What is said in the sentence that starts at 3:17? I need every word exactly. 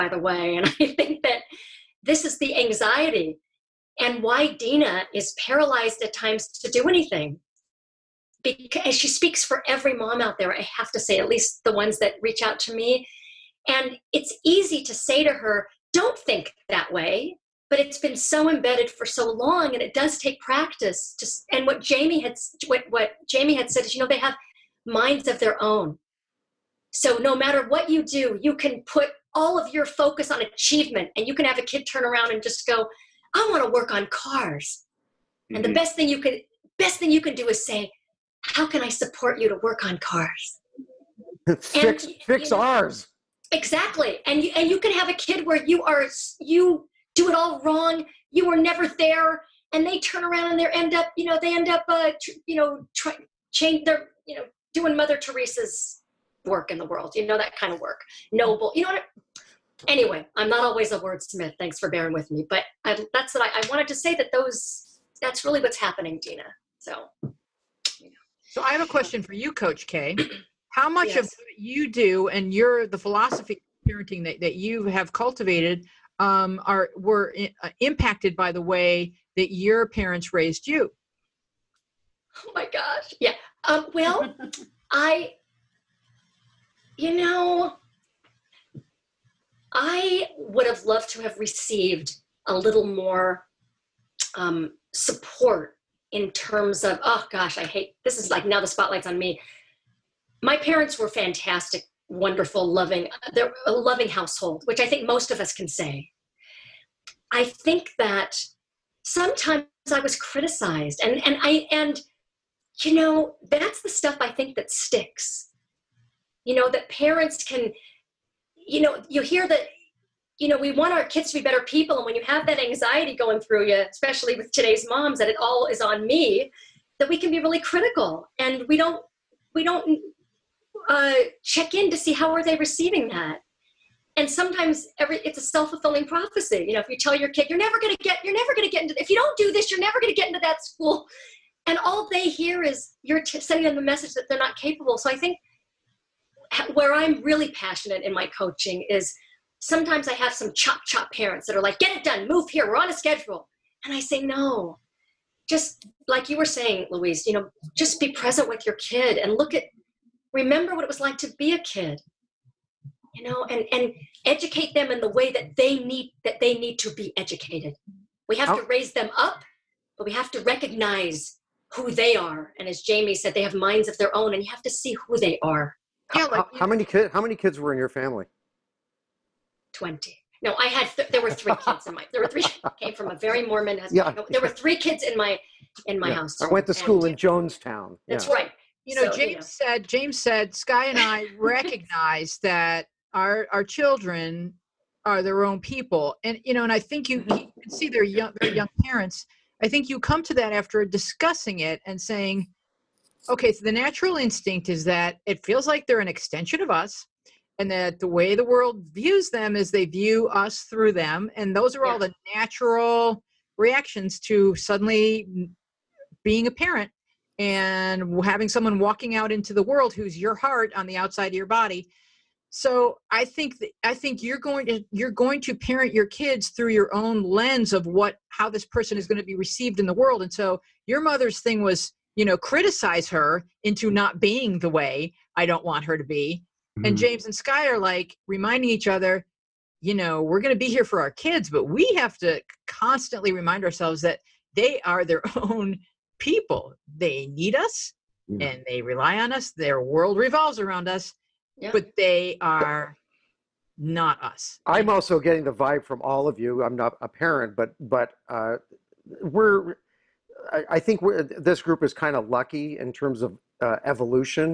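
you can see their young their young parents.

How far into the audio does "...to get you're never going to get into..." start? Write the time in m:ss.
2:17.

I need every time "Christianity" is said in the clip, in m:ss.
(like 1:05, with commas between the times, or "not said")
not said.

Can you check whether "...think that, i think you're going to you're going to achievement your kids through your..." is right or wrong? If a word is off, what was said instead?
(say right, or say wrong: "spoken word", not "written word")
wrong: "parent", not "achievement".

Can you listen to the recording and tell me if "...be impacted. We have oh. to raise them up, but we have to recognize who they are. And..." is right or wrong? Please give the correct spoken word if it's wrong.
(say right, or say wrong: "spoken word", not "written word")
wrong: "educated", not "impacted".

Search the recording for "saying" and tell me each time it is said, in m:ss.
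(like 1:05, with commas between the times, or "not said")
2:36, 3:21.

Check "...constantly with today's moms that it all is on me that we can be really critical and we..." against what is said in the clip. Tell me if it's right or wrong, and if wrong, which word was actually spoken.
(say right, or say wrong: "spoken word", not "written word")
wrong: "especially", not "constantly".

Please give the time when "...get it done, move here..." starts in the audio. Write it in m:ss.
2:31.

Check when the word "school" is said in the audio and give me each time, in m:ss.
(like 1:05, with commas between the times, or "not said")
2:20, 3:06.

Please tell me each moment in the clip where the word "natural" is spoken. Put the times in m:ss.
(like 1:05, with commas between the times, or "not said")
3:23, 3:32.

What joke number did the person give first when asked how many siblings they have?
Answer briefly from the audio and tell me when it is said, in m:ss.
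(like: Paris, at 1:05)
20, at 2:59.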